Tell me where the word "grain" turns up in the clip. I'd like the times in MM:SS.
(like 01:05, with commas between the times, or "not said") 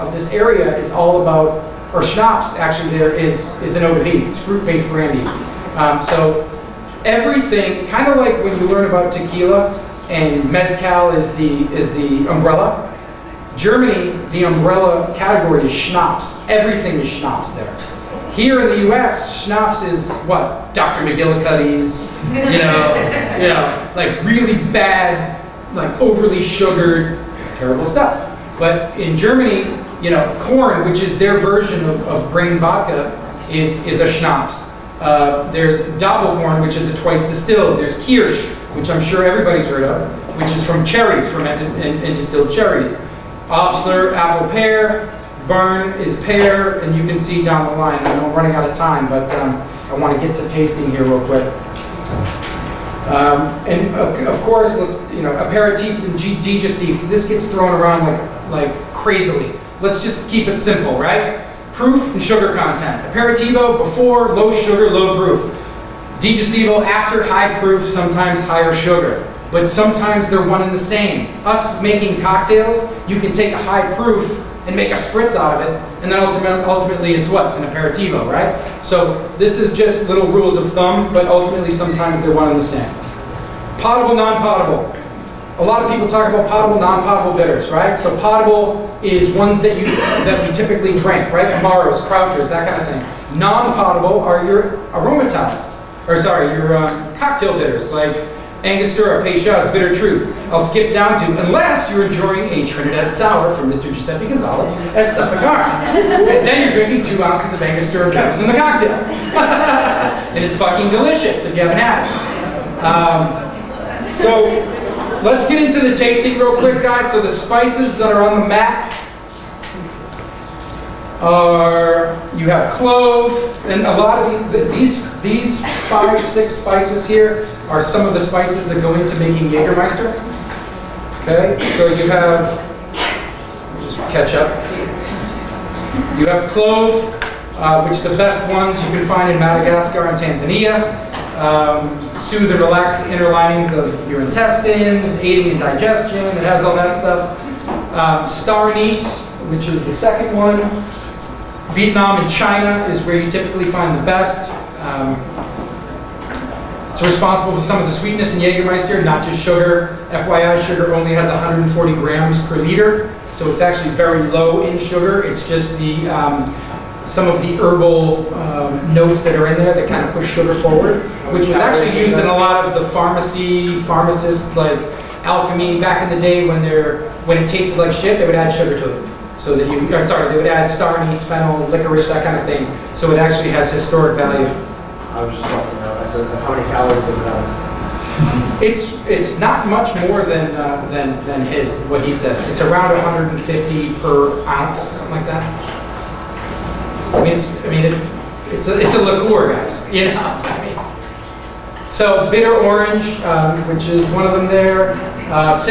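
00:32.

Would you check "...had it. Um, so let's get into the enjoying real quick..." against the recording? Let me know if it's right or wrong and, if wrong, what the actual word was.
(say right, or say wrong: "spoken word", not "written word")
wrong: "tasting", not "enjoying".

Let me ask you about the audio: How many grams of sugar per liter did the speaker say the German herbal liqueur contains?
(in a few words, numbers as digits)
140.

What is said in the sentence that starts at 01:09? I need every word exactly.
But sometimes they're one and the same.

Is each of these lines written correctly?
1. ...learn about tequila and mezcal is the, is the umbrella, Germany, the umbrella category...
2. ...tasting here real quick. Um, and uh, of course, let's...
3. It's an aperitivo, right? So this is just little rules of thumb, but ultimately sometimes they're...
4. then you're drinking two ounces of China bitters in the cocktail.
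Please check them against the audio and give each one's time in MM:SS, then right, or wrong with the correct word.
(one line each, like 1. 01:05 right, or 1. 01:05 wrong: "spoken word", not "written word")
1. 00:08 right
2. 00:50 right
3. 01:17 right
4. 01:45 wrong: "Angostura", not "China".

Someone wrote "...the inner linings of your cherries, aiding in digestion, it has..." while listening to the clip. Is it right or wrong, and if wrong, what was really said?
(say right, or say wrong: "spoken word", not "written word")
wrong: "intestines", not "cherries".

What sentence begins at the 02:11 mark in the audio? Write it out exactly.
Okay, so you have, just ketchup.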